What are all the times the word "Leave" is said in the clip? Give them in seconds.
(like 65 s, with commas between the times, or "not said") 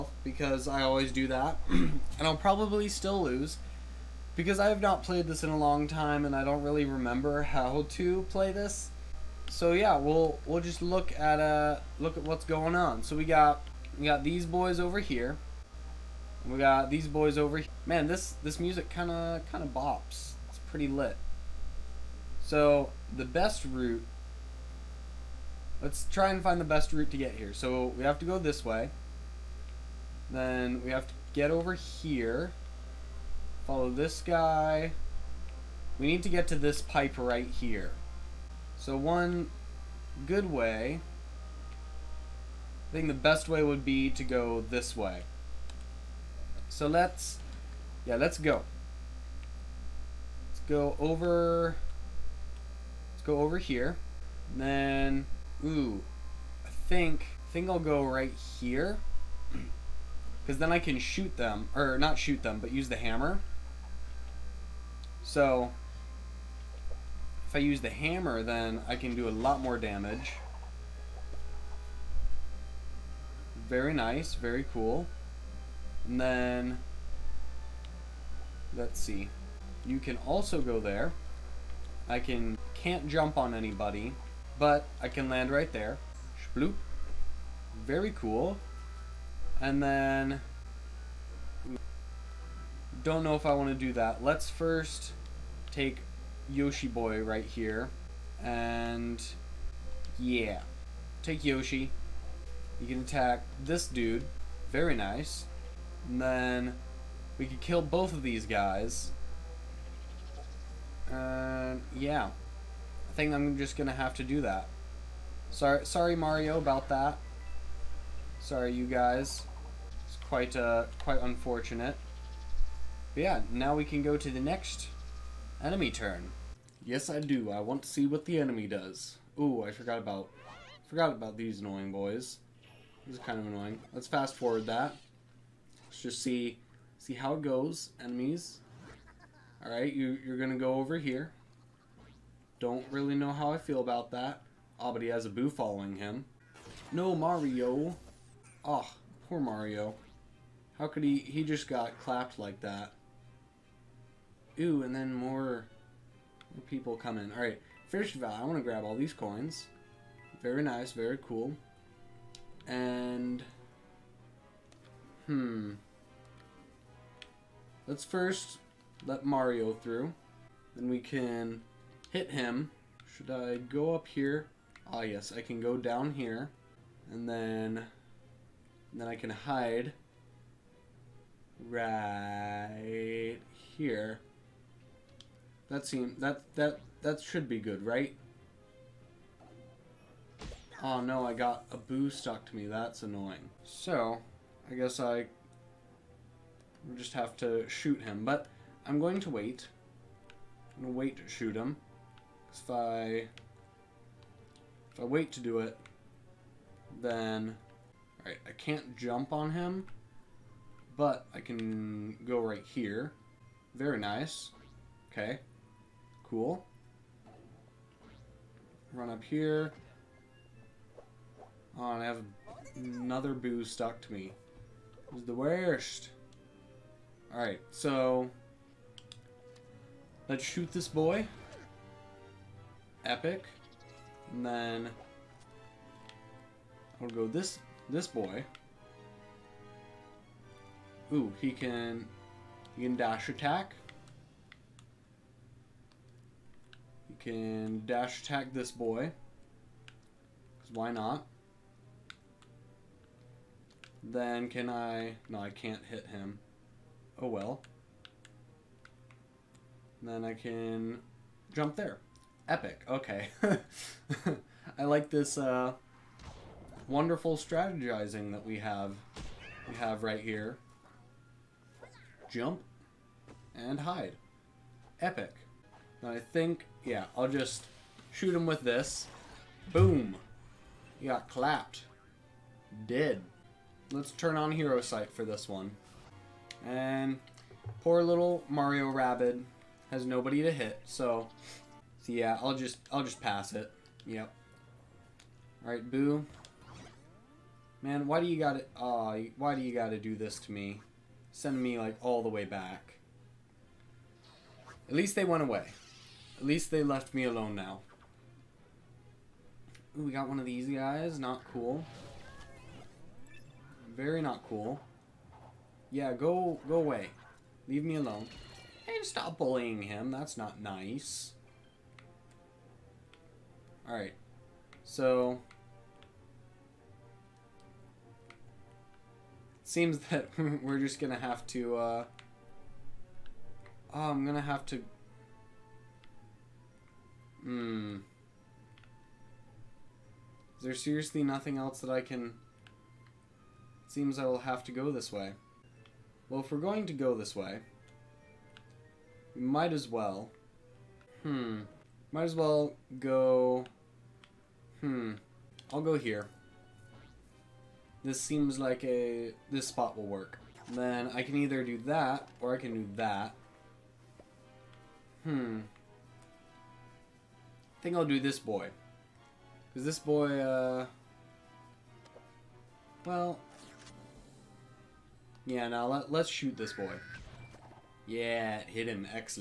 317 s.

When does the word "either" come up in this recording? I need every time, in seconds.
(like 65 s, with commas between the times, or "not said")
361 s.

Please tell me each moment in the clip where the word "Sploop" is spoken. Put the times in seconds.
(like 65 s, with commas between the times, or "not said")
86 s.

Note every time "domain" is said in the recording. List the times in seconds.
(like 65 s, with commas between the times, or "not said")
not said.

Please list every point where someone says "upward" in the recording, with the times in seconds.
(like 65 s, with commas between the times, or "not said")
not said.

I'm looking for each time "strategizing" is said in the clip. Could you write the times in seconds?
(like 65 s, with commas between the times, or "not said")
267 s.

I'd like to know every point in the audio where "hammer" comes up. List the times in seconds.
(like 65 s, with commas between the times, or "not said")
62 s, 67 s.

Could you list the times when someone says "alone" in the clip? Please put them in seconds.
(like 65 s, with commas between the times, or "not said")
307 s, 317 s.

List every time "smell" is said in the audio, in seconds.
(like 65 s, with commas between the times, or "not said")
not said.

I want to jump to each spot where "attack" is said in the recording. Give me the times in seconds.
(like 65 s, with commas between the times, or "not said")
103 s, 243 s, 248 s.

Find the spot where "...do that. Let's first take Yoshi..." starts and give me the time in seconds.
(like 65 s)
93 s.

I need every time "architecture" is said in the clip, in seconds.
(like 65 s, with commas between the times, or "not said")
not said.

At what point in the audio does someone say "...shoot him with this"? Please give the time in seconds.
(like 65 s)
278 s.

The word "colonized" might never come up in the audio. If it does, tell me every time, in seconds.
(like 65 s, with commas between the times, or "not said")
not said.